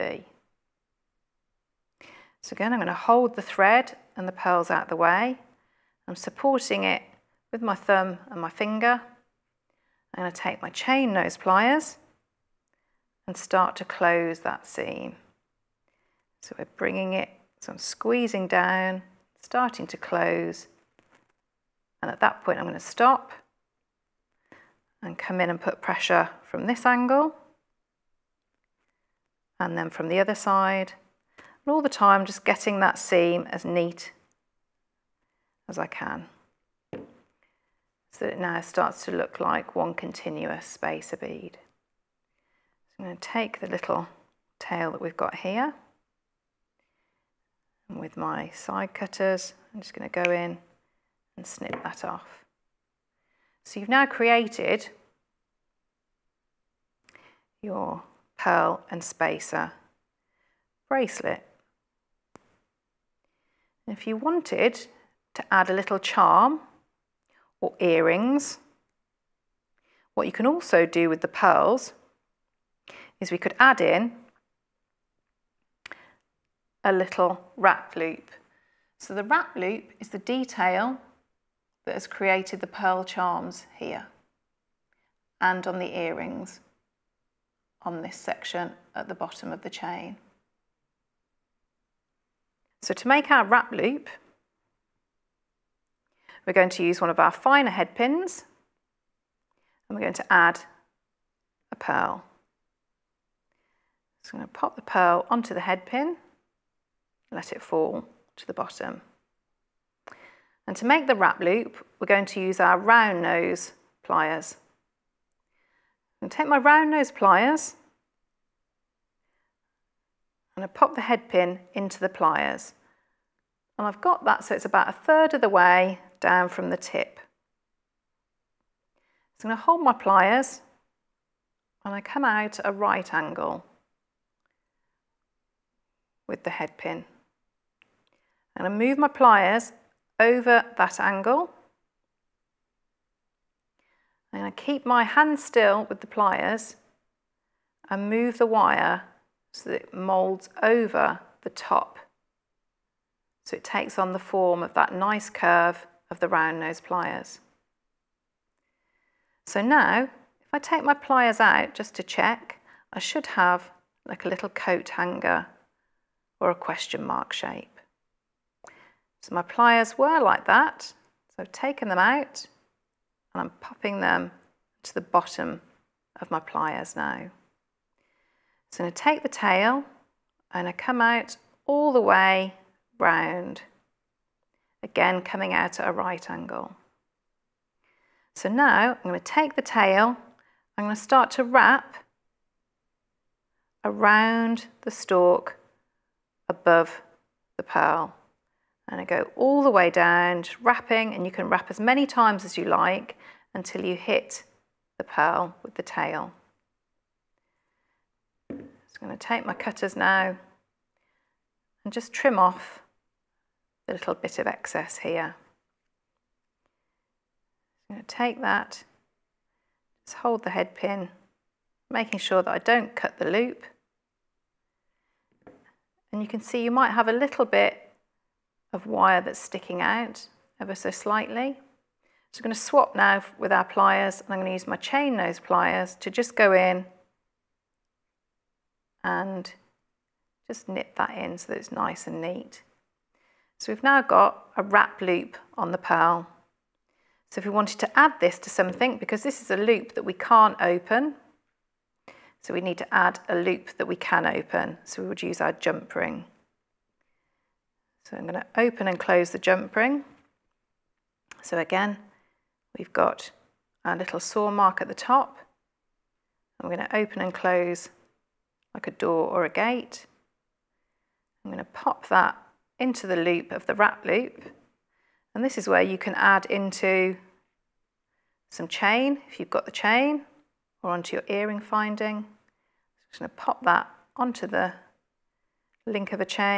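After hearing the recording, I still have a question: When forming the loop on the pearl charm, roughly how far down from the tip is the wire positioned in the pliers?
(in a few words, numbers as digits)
a third.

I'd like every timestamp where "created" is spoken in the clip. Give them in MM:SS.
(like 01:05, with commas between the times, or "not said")
00:54, 01:22.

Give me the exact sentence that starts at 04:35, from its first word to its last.
And this is where you can add into some chain, if you've got the chain, or onto your earring finding.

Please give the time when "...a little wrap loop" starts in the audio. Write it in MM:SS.
01:16.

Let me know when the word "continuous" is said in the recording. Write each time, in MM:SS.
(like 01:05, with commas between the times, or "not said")
00:39.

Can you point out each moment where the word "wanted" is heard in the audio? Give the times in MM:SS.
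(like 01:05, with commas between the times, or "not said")
01:04, 04:07.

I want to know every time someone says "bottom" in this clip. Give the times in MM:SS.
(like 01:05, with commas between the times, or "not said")
01:29, 01:48, 02:55.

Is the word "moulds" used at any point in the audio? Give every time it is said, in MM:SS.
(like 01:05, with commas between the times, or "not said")
02:29.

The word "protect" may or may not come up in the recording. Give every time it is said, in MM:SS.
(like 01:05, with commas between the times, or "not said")
not said.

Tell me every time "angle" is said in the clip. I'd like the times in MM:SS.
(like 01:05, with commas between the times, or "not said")
00:26, 02:13, 02:20, 03:06.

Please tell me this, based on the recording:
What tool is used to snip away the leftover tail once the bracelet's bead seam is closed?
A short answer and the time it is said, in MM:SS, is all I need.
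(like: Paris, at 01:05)
side cutters, at 00:48.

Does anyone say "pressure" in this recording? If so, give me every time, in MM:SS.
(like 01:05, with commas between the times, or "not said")
00:25.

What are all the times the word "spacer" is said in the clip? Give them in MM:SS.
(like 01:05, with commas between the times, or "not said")
00:40, 00:59.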